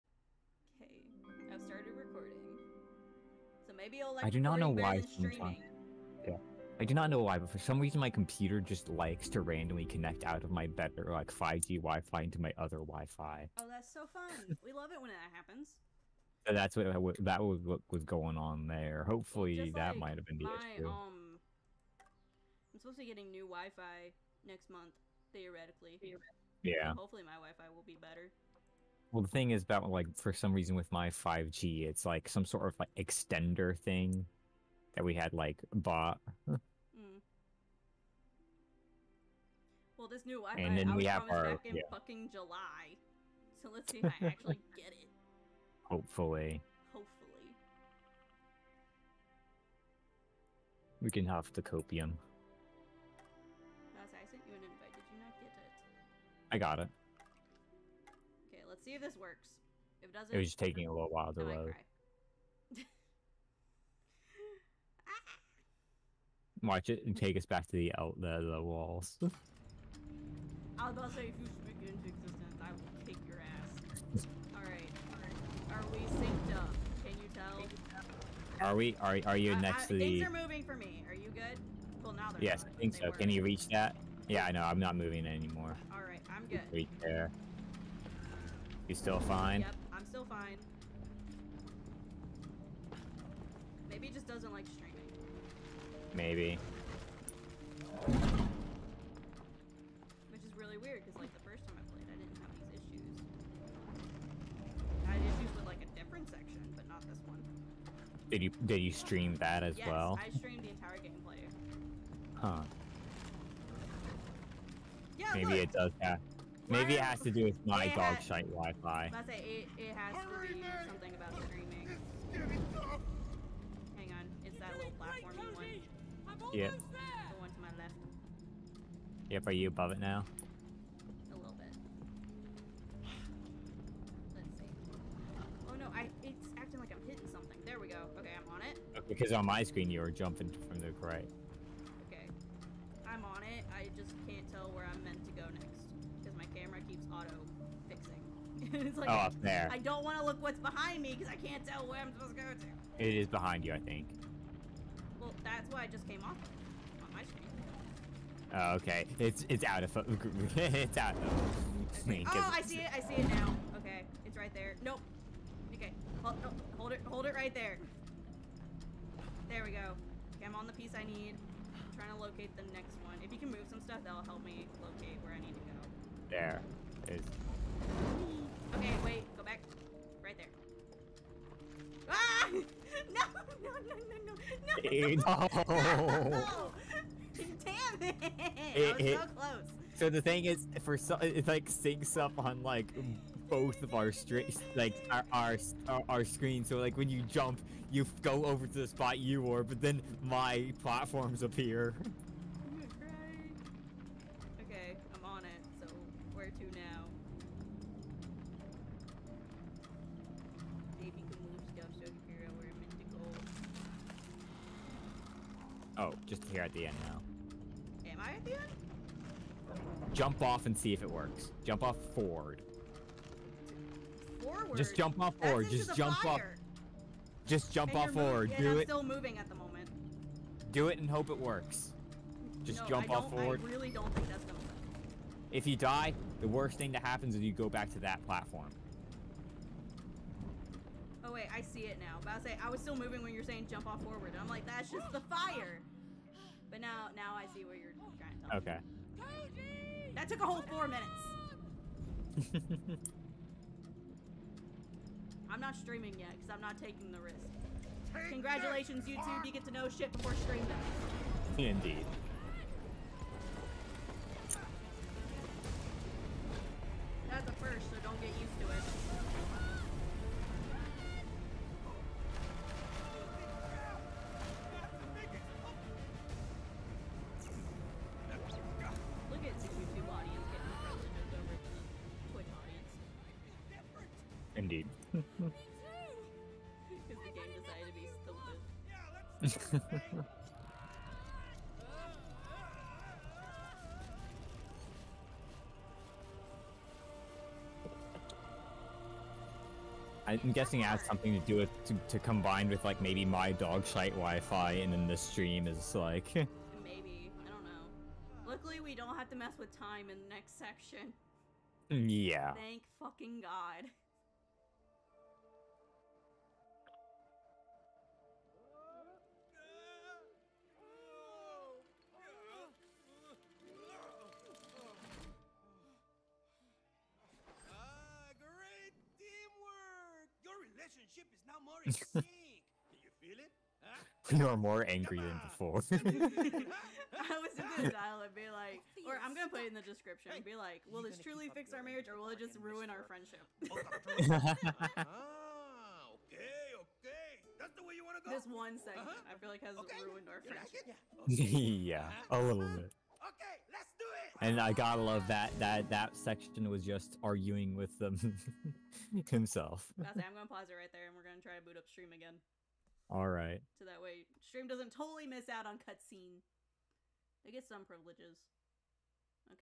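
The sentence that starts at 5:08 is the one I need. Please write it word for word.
Luckily, we don't have to mess with time in the next section.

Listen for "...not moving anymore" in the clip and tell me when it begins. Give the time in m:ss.
1:24.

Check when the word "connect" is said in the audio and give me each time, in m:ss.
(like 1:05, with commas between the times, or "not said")
0:09.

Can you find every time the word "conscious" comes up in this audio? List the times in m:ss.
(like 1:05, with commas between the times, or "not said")
not said.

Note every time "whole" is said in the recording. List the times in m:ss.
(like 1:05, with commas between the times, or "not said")
4:10.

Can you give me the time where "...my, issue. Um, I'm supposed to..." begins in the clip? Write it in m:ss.
0:20.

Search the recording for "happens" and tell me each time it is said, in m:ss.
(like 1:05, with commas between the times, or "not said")
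0:15, 3:57.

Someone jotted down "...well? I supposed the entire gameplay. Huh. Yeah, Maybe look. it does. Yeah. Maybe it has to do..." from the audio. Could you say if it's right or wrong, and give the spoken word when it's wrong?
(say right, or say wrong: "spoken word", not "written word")
wrong: "streamed", not "supposed".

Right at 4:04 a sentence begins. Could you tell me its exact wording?
And I'm like, that's just the fire.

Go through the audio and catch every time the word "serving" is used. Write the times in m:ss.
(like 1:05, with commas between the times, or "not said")
not said.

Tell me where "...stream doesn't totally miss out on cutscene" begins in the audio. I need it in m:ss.
6:04.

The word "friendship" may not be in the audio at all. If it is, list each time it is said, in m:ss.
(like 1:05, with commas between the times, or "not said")
5:43, 5:50.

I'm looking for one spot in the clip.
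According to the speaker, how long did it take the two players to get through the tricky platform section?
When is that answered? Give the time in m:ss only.
4:10.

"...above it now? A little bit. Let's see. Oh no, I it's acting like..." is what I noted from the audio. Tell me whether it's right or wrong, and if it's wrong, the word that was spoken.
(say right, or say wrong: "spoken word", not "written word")
right.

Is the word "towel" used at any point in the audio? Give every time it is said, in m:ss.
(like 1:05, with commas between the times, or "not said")
not said.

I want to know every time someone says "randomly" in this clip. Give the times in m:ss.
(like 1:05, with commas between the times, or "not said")
0:09.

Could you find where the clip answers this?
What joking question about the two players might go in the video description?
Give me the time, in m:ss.
5:41.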